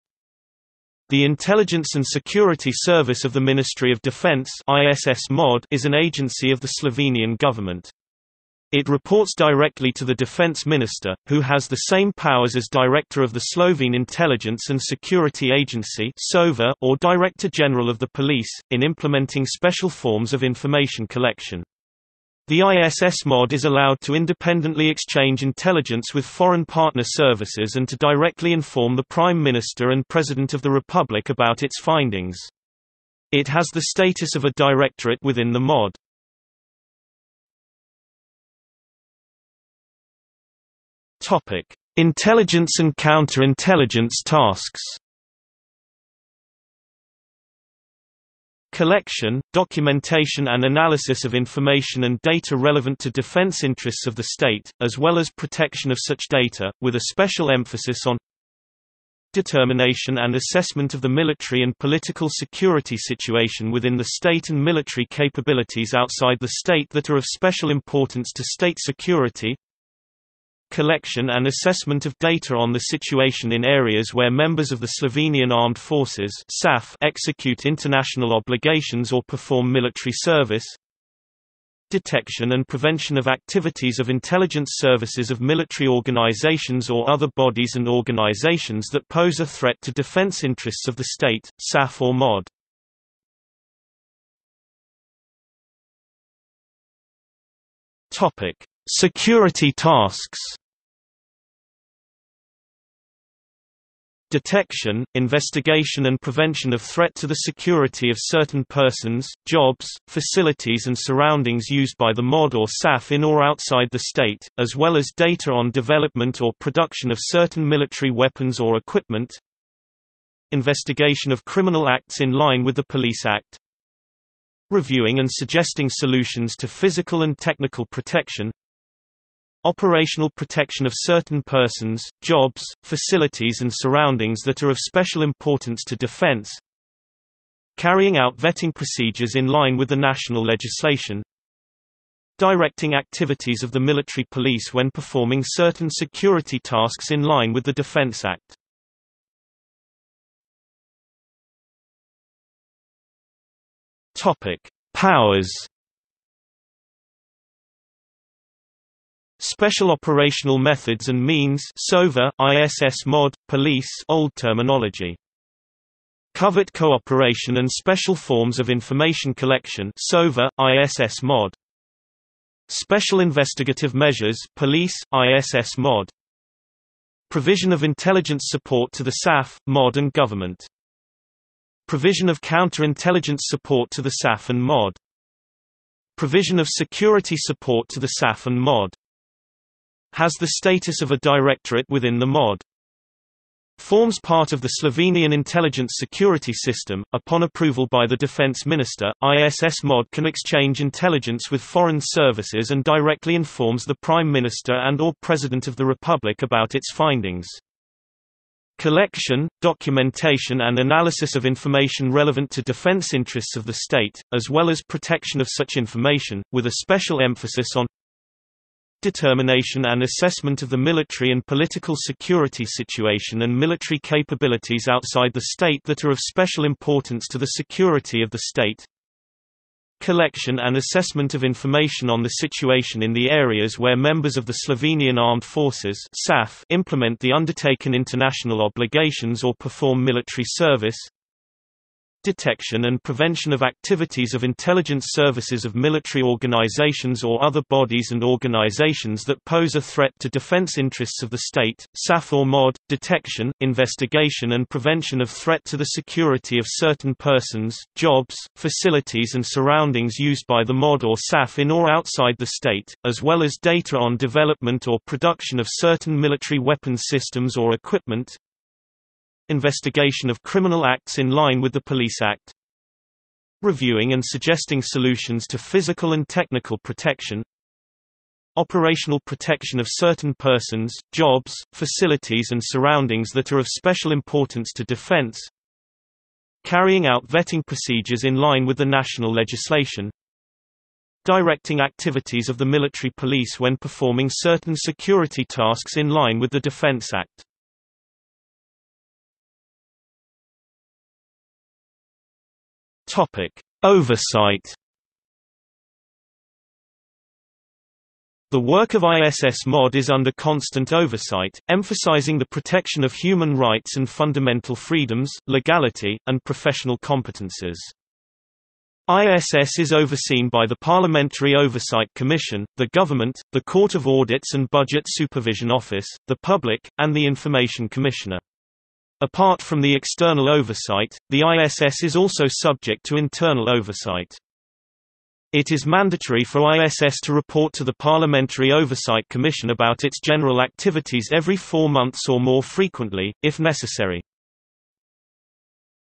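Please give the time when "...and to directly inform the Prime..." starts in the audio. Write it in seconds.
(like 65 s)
27 s.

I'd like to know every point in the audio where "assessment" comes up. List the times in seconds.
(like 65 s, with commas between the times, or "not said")
60 s, 71 s, 220 s, 230 s.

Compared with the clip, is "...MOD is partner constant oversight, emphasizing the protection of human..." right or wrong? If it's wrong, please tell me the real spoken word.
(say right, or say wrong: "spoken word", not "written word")
wrong: "under", not "partner".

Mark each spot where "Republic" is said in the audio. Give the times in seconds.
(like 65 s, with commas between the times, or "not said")
30 s, 205 s.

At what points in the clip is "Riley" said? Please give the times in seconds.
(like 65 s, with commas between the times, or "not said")
not said.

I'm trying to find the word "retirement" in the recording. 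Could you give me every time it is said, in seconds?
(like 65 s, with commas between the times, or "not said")
not said.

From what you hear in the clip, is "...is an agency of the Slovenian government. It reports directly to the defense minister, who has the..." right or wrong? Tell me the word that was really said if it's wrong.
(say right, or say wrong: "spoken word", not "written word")
right.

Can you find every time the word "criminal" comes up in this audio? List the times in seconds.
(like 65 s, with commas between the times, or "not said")
121 s, 270 s.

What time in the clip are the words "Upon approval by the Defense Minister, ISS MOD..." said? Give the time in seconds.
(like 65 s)
197 s.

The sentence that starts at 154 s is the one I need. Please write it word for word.
Topic: Powers Special Operational Methods and Means SOVA, ISS mod, police old terminology.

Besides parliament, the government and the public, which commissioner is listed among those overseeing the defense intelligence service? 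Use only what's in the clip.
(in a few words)
Information Commissioner.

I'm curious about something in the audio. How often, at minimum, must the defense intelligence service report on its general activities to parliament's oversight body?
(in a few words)
Every 4 months.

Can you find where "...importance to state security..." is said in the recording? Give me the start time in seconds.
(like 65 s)
67 s.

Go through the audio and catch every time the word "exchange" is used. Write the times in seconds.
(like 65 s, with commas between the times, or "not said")
24 s, 200 s.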